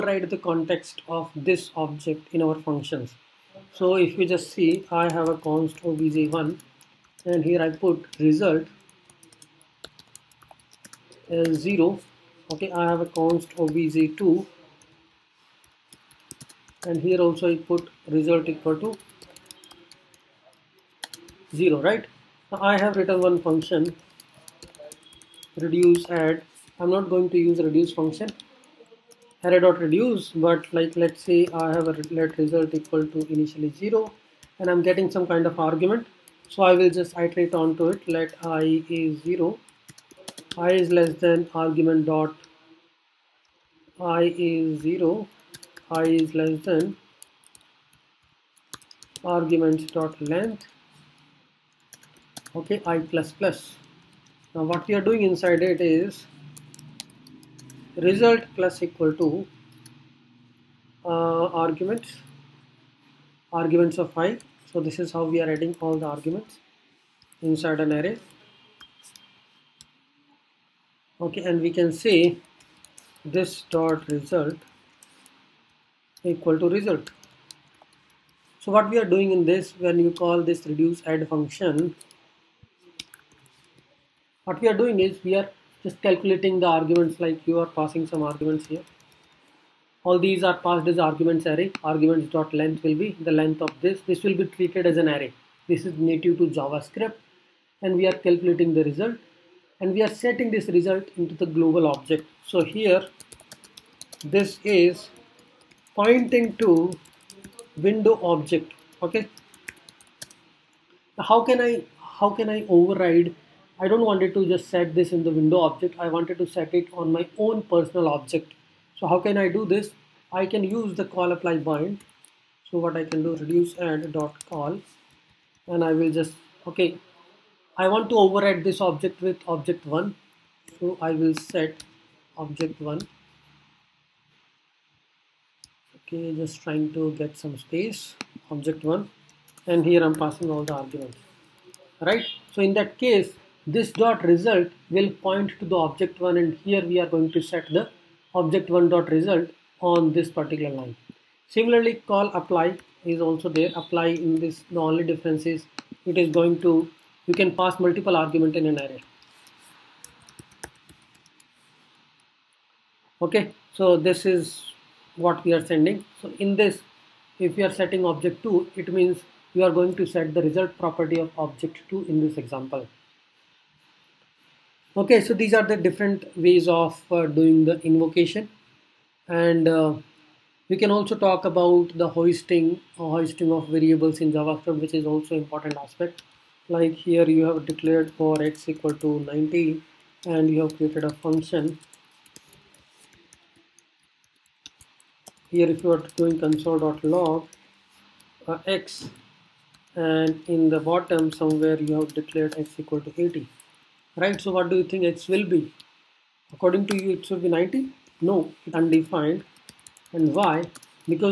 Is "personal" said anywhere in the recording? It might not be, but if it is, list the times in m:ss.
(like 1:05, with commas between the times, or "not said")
1:57.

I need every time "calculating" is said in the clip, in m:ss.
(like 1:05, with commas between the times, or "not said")
1:26, 1:38.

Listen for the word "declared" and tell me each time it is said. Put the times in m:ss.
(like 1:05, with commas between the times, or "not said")
3:07, 3:22.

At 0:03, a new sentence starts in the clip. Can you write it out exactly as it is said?
So if you just see, I have a const obj1 and here I put result as 0.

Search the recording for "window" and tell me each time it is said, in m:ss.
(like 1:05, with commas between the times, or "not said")
1:47, 1:55.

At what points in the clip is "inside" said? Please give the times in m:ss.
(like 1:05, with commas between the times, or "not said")
0:55, 1:07.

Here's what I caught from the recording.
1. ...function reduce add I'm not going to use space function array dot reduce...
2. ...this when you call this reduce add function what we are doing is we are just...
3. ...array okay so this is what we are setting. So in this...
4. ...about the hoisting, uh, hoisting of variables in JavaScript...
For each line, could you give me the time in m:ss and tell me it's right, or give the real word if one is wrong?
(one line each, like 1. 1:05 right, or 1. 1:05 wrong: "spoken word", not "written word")
1. 0:23 wrong: "reduce", not "space"
2. 1:19 right
3. 2:38 wrong: "sending", not "setting"
4. 3:01 right.